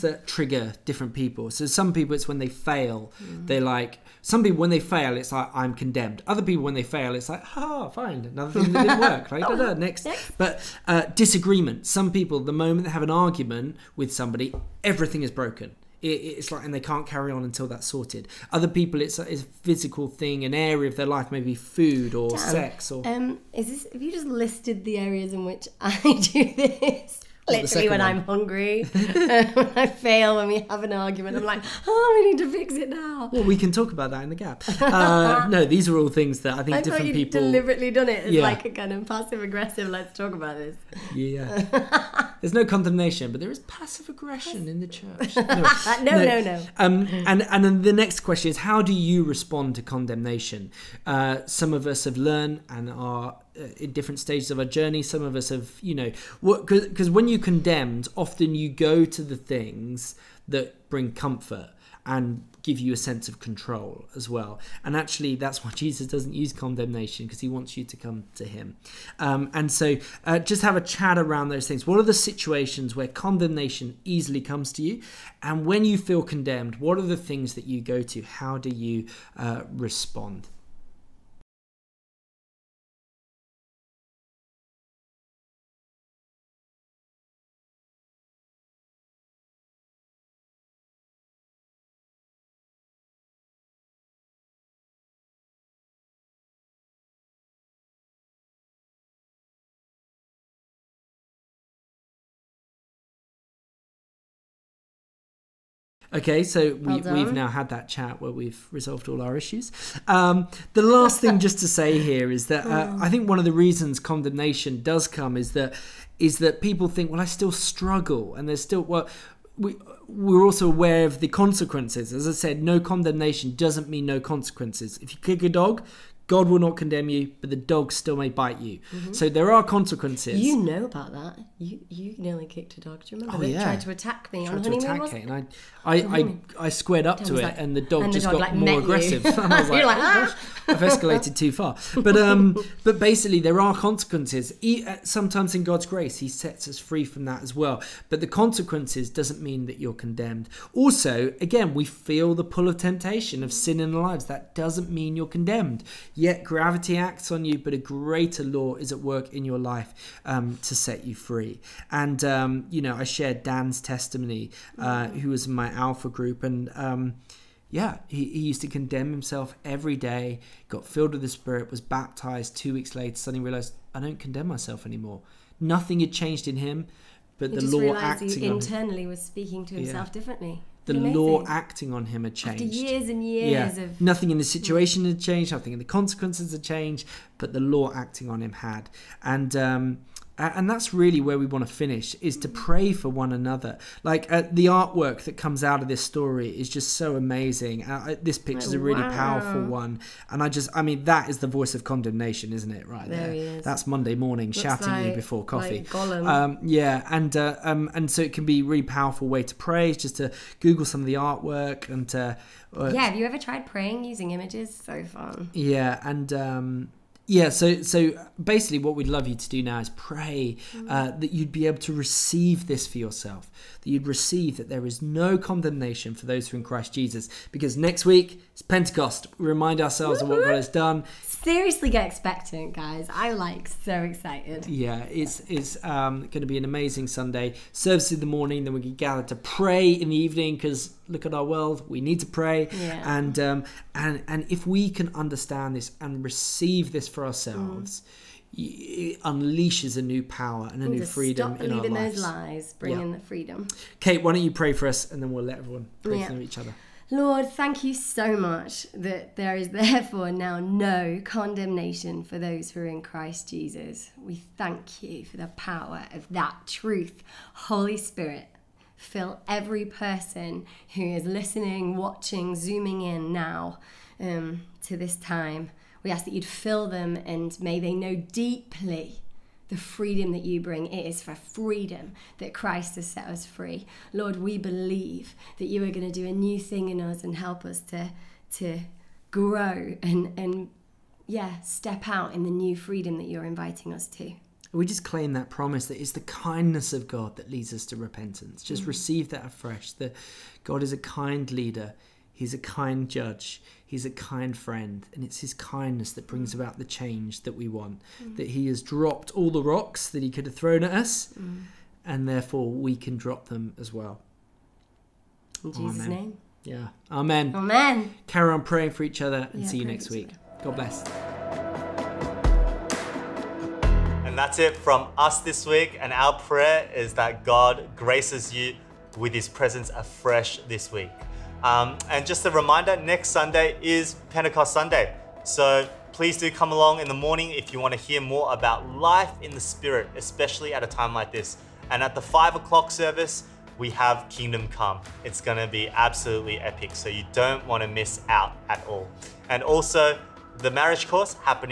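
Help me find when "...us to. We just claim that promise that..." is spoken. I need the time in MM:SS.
04:53.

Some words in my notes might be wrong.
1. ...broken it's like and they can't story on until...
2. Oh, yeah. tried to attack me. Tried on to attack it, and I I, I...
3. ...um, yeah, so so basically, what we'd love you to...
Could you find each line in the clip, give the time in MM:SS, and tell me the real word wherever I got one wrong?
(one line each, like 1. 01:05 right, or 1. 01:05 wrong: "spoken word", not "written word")
1. 00:15 wrong: "carry", not "story"
2. 02:13 right
3. 03:36 right.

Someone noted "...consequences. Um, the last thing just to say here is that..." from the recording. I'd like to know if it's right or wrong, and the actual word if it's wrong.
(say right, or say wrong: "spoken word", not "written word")
wrong: "issues", not "consequences".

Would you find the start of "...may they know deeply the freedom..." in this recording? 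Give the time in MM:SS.
04:37.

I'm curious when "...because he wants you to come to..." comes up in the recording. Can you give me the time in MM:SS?
01:07.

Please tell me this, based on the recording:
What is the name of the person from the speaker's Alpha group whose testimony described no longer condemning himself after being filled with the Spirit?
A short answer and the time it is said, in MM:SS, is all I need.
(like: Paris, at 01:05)
Dan, at 02:43.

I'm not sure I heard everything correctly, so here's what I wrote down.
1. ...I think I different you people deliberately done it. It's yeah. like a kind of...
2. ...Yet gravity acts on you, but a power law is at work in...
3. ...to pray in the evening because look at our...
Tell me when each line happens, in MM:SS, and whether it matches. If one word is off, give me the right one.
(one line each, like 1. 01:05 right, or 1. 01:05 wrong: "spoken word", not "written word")
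1. 00:36 right
2. 02:36 wrong: "greater", not "power"
3. 03:59 right.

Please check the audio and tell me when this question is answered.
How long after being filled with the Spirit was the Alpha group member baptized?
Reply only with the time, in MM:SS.
02:52.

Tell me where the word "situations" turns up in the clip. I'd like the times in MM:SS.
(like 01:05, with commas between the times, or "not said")
01:12, 03:04.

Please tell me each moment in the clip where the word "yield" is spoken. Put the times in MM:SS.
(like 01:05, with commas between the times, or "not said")
not said.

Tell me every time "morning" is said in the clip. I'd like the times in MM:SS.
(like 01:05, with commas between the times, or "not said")
03:24, 03:58, 05:37.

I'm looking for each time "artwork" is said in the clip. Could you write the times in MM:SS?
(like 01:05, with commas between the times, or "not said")
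03:14, 03:31.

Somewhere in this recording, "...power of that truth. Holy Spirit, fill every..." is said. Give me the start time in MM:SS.
04:25.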